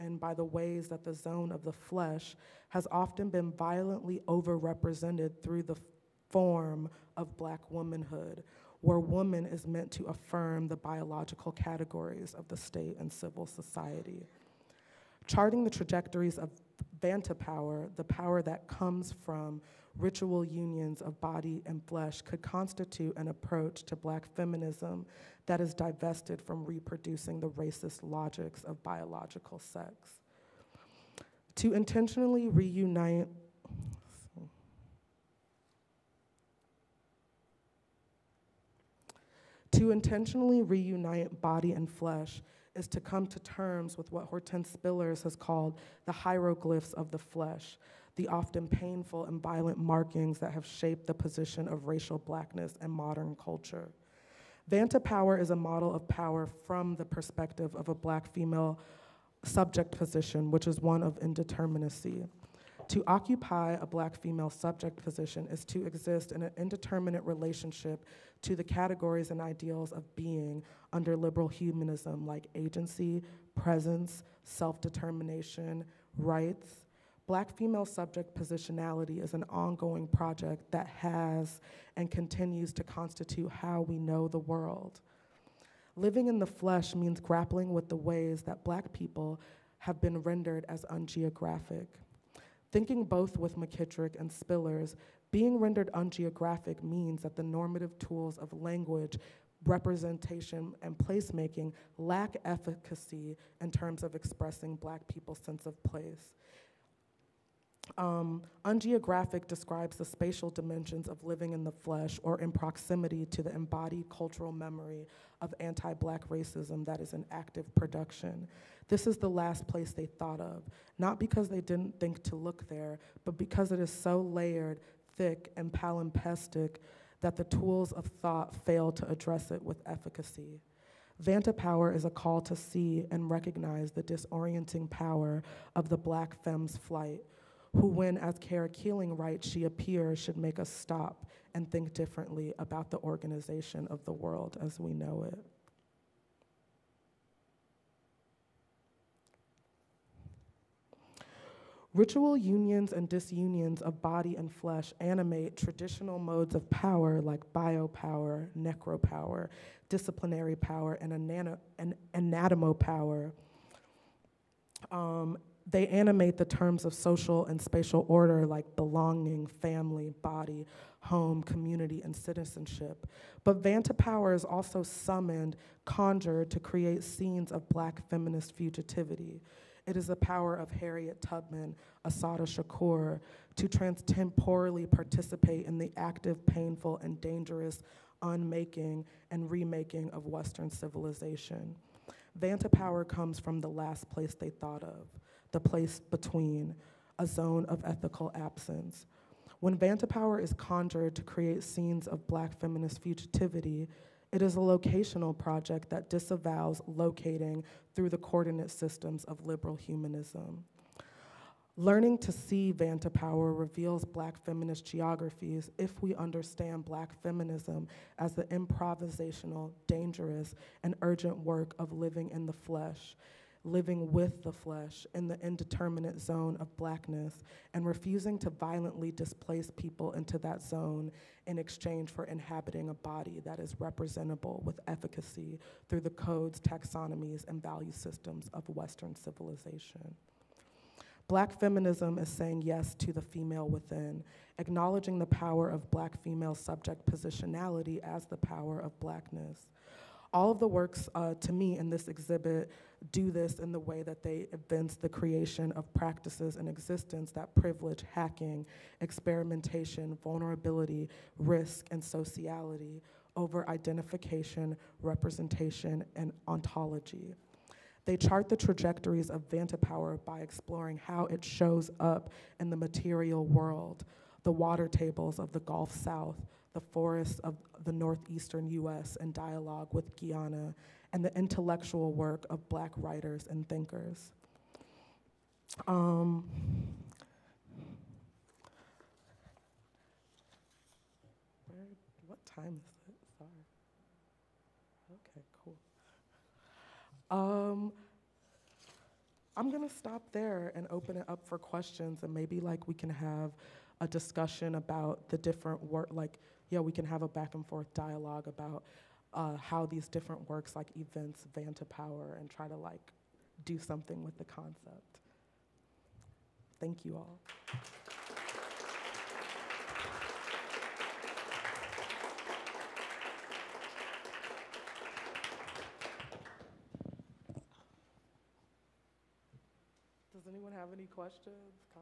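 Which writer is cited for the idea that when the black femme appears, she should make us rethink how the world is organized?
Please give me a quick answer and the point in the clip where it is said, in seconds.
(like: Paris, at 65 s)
Kara Keeling, at 138 s.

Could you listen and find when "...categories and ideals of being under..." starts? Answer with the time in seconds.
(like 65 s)
68 s.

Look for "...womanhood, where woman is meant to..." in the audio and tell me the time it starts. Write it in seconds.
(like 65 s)
7 s.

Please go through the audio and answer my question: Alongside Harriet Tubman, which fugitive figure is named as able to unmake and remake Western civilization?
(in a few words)
Assata Shakur.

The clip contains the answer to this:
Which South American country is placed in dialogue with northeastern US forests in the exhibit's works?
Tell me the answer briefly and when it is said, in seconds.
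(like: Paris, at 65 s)
Guyana, at 280 s.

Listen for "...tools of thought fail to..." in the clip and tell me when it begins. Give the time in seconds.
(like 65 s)
127 s.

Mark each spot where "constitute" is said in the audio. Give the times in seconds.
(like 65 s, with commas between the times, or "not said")
22 s, 82 s.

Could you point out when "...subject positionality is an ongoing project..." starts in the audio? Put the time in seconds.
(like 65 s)
77 s.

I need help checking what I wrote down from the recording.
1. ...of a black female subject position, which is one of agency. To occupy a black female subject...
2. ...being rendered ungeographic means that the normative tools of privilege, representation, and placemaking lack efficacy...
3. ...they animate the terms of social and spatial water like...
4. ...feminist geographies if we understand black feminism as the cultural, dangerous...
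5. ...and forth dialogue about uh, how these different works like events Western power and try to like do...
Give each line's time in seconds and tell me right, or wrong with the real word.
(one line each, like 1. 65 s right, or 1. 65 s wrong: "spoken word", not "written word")
1. 57 s wrong: "indeterminacy", not "agency"
2. 95 s wrong: "language", not "privilege"
3. 165 s wrong: "order", not "water"
4. 214 s wrong: "improvisational", not "cultural"
5. 307 s wrong: "Vanta", not "Western".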